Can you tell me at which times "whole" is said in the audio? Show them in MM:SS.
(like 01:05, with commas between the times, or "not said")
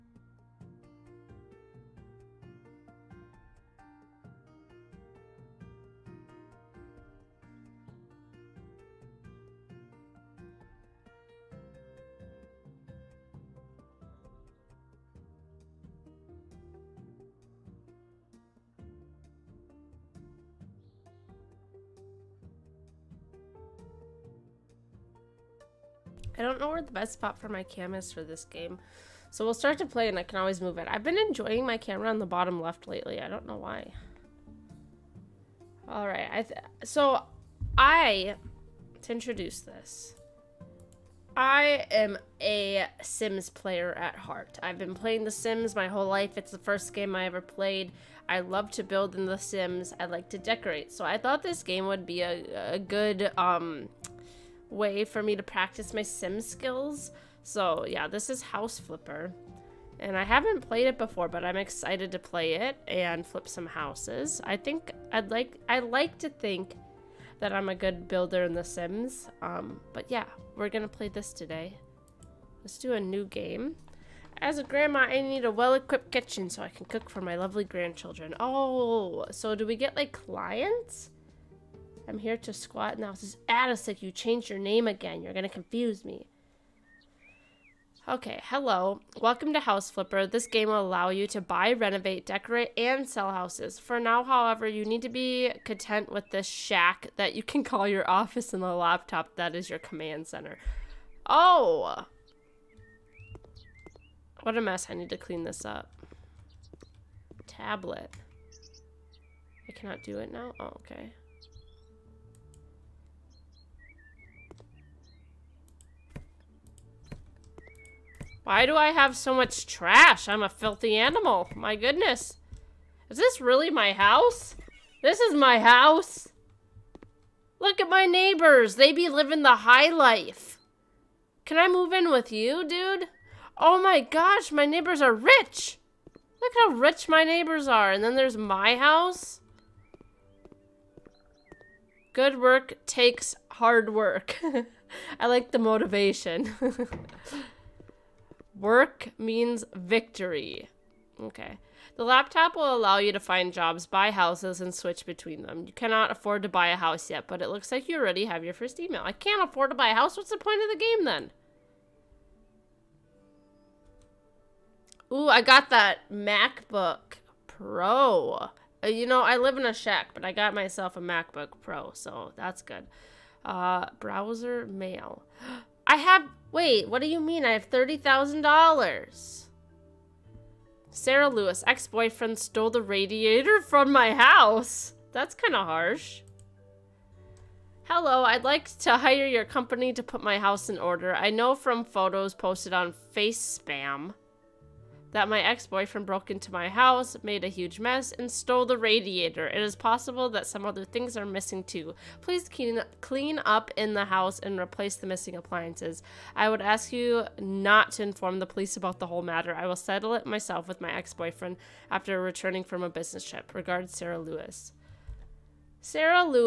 00:45, 03:29.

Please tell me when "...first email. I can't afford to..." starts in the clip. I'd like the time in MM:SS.
02:38.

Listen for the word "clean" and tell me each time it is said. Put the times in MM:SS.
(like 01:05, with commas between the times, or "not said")
01:45, 03:22.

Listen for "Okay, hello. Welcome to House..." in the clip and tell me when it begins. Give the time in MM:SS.
01:28.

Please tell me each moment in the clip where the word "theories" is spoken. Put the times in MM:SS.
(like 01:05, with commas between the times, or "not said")
not said.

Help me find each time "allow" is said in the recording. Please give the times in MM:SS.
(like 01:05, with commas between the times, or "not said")
01:30, 02:32.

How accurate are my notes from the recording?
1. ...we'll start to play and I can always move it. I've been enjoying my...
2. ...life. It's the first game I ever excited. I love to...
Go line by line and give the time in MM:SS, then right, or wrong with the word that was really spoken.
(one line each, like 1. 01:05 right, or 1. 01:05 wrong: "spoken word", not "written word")
1. 00:29 right
2. 00:46 wrong: "played", not "excited".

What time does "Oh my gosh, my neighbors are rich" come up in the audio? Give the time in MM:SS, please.
02:13.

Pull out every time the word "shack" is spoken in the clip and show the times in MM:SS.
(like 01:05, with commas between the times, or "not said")
01:36, 02:49.